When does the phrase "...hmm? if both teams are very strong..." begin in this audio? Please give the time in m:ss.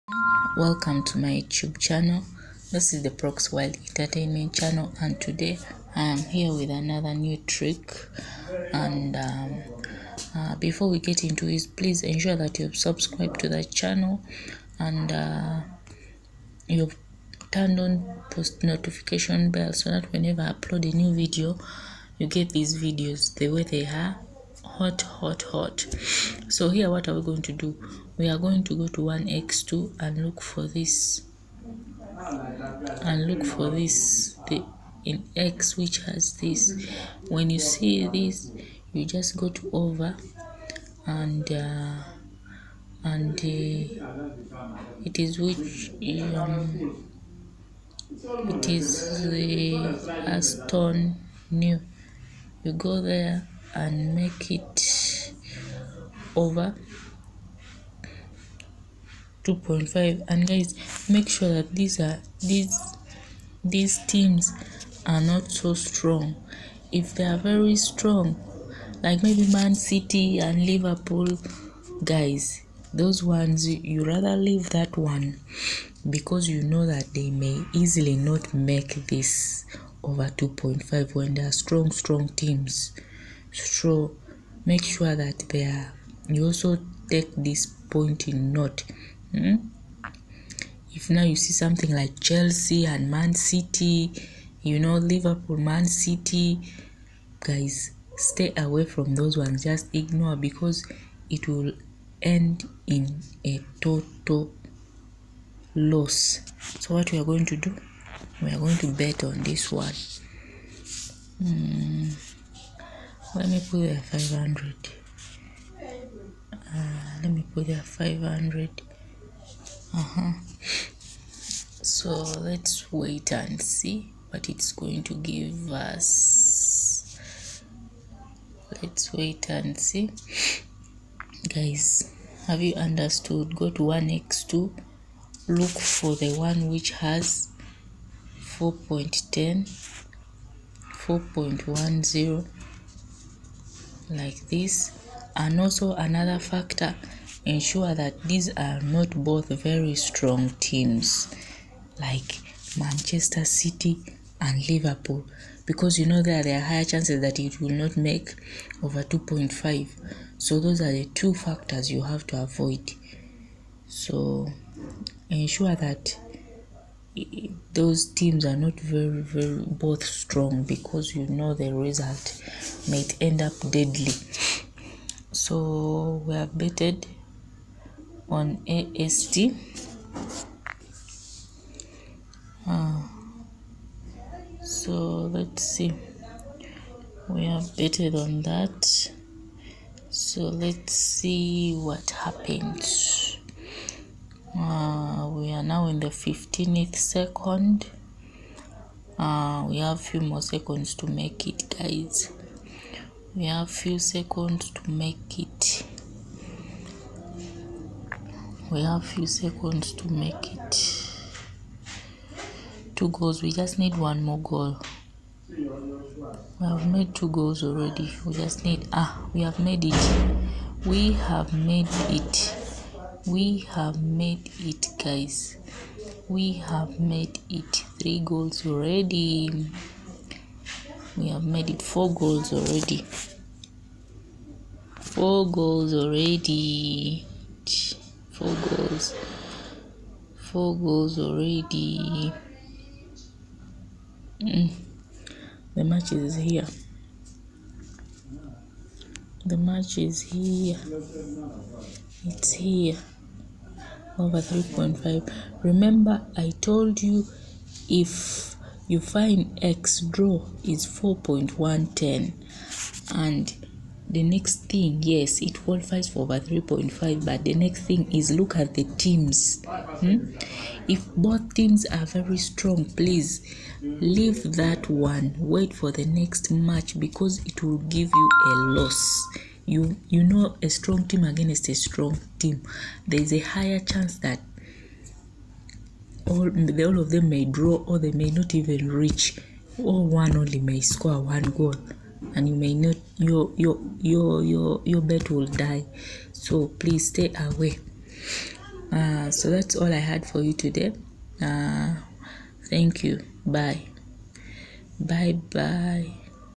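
4:29.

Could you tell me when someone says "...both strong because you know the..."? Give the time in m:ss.
2:49.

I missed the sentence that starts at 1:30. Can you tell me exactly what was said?
If now you see something like Chelsea and Man City, you know, Liverpool, Man City, guys, stay away from those ones.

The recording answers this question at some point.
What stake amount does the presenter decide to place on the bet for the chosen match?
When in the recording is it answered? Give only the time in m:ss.
1:53.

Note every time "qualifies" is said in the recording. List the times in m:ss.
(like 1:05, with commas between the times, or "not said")
4:25.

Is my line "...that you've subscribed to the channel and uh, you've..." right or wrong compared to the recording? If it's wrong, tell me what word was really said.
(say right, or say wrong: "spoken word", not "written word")
right.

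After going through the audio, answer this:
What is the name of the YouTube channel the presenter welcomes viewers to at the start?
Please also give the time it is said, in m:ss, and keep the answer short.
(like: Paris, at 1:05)
Prox Wild Entertainment, at 0:03.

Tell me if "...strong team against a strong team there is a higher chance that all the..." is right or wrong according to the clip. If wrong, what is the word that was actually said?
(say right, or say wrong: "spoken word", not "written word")
right.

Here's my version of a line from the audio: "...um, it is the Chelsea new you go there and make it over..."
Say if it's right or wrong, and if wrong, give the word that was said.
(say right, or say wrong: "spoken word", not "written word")
wrong: "Aston", not "Chelsea".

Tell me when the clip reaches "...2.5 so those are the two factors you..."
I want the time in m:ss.
2:39.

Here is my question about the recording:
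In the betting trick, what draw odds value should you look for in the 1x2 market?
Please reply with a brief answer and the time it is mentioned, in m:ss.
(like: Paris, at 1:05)
4.10, at 2:18.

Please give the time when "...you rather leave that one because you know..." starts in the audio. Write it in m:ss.
1:13.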